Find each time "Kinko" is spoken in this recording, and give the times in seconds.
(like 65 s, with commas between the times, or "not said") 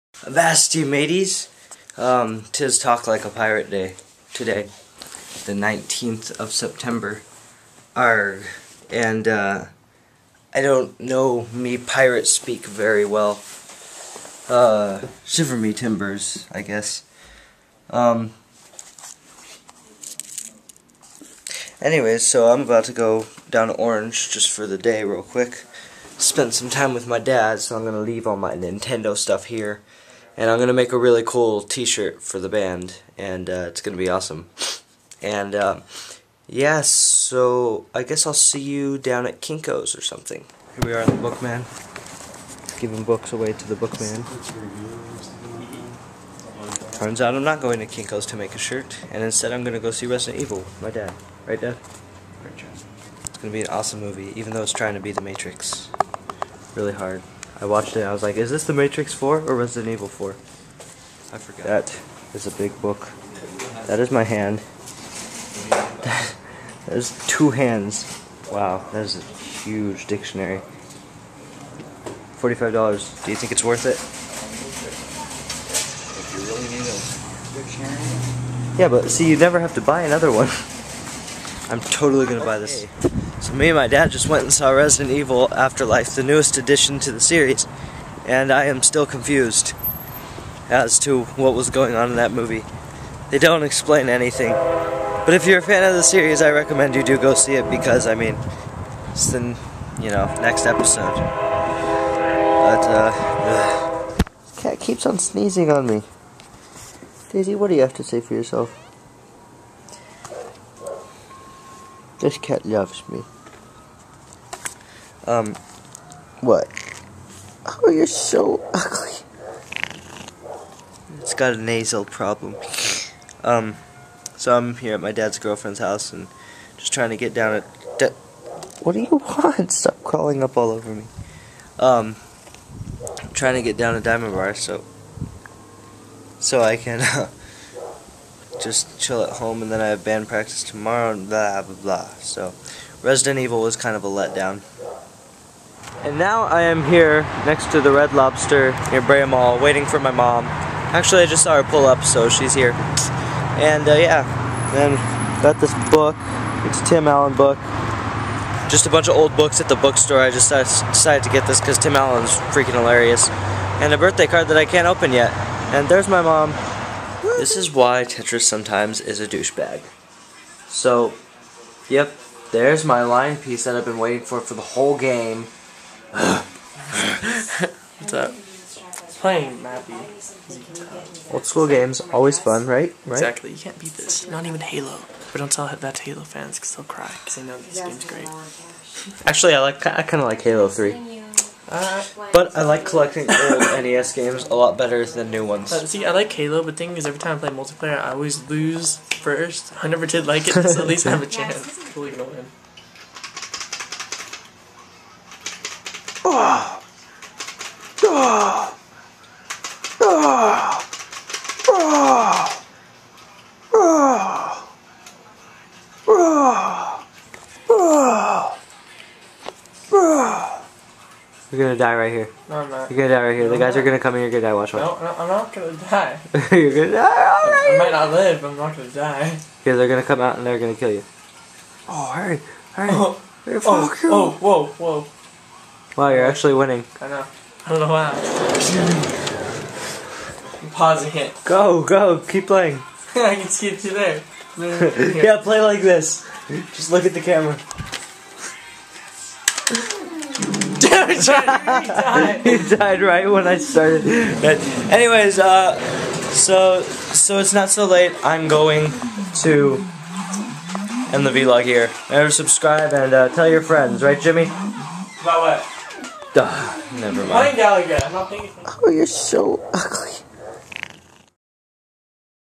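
39 s, 47 s.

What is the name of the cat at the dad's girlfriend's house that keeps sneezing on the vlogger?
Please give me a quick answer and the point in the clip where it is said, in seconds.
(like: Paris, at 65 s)
Daisy, at 107 s.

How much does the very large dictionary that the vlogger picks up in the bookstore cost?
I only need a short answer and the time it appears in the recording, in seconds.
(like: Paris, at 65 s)
$45, at 72 s.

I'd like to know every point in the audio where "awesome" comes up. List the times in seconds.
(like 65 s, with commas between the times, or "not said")
34 s, 53 s.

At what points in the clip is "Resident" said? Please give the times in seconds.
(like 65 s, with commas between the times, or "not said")
50 s, 59 s, 84 s, 143 s.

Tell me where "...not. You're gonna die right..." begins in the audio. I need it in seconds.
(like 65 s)
222 s.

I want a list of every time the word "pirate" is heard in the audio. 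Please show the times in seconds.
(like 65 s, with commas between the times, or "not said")
3 s, 11 s.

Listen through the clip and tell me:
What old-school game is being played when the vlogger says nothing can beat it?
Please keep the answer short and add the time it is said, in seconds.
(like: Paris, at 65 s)
Mappy, at 179 s.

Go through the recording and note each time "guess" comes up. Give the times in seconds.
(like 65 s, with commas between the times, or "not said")
16 s, 38 s.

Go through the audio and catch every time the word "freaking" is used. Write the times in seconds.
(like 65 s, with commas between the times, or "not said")
162 s.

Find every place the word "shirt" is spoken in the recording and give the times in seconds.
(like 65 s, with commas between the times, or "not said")
31 s, 48 s.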